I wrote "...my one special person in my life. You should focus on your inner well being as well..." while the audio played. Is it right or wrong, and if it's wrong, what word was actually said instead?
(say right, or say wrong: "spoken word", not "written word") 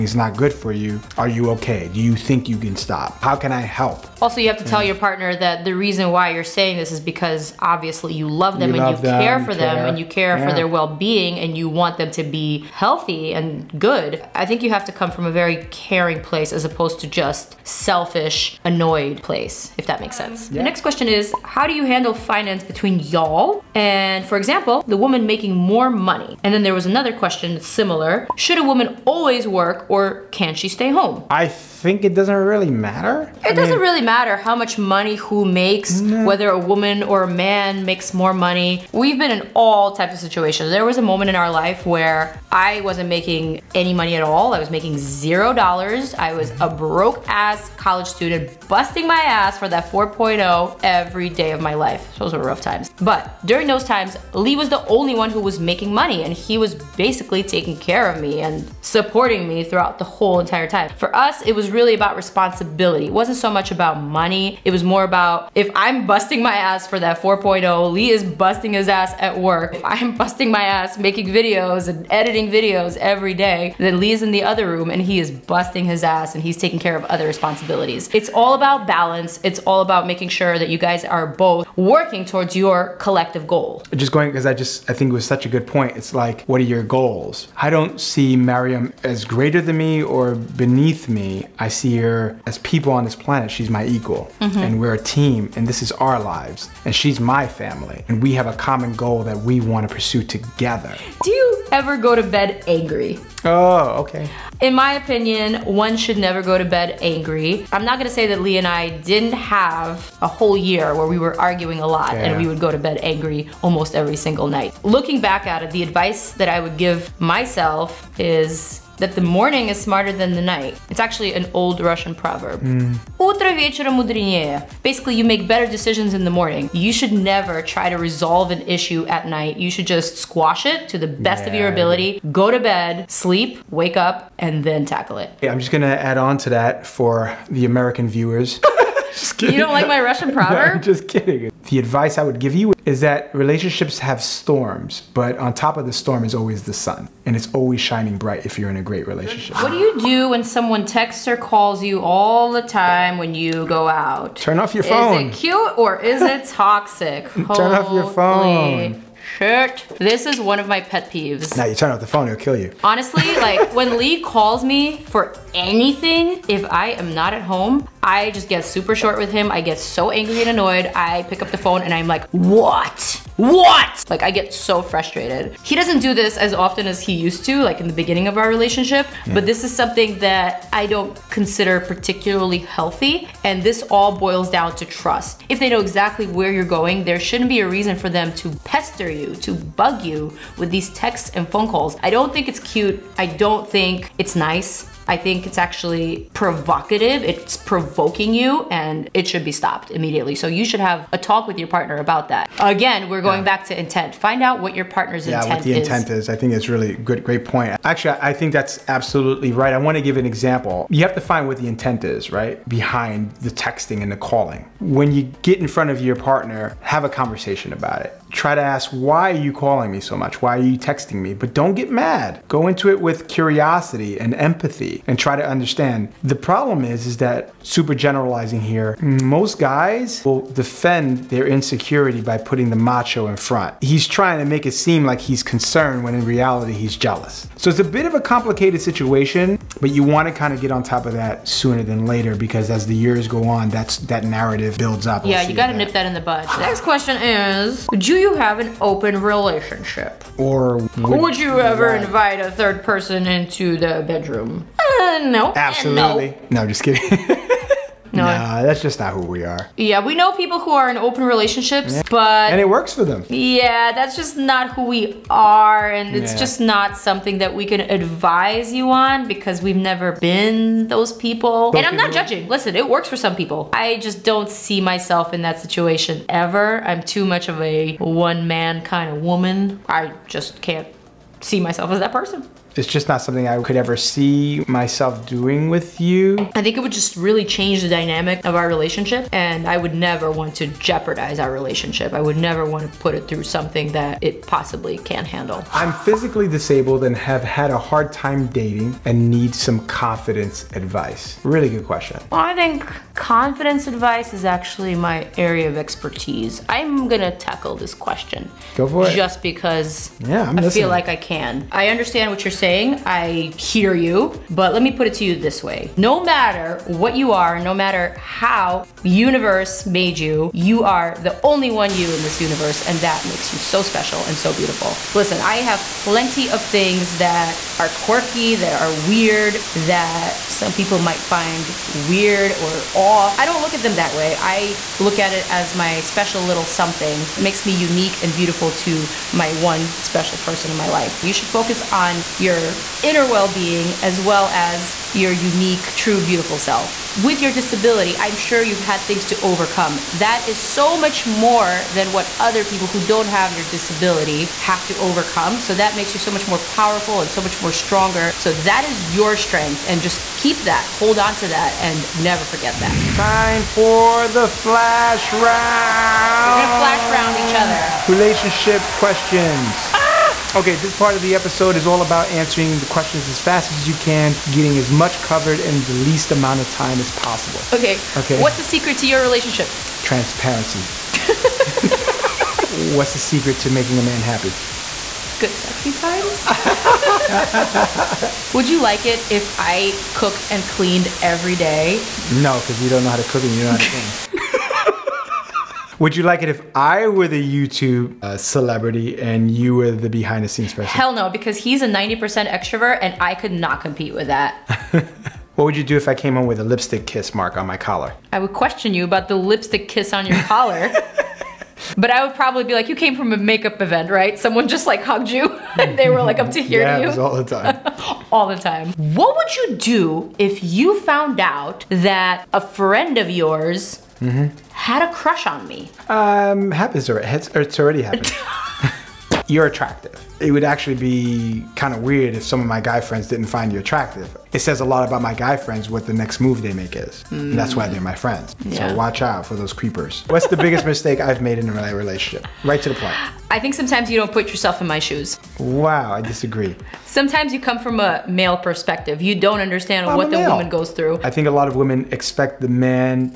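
right.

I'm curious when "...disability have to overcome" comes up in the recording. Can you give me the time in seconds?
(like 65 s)
353 s.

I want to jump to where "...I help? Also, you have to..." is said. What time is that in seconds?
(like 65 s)
3 s.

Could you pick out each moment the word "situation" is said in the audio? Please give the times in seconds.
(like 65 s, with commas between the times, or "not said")
40 s, 238 s, 275 s.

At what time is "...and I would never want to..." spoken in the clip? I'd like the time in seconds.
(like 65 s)
289 s.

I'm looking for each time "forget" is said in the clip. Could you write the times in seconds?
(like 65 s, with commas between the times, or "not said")
362 s.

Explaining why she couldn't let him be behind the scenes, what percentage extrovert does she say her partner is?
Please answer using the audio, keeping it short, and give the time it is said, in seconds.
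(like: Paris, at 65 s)
90%, at 401 s.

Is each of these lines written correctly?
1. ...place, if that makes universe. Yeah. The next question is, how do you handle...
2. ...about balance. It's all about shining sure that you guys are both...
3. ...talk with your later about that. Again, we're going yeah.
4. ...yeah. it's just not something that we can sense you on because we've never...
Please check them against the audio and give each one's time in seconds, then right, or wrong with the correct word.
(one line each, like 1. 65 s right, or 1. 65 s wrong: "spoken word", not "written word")
1. 19 s wrong: "sense", not "universe"
2. 78 s wrong: "making", not "shining"
3. 201 s wrong: "partner", not "later"
4. 266 s wrong: "advise", not "sense".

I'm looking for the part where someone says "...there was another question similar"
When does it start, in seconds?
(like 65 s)
26 s.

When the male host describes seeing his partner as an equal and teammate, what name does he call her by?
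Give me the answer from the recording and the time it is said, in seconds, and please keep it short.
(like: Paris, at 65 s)
Maryam, at 88 s.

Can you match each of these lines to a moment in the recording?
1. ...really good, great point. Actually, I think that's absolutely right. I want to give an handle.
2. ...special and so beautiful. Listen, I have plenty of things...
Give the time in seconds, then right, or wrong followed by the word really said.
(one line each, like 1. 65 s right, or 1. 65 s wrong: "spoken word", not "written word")
1. 206 s wrong: "example", not "handle"
2. 323 s right.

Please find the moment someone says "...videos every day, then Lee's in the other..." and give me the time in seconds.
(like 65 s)
72 s.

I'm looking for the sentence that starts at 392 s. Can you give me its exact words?
No, because you don't know how to cook and you don't know how to clean.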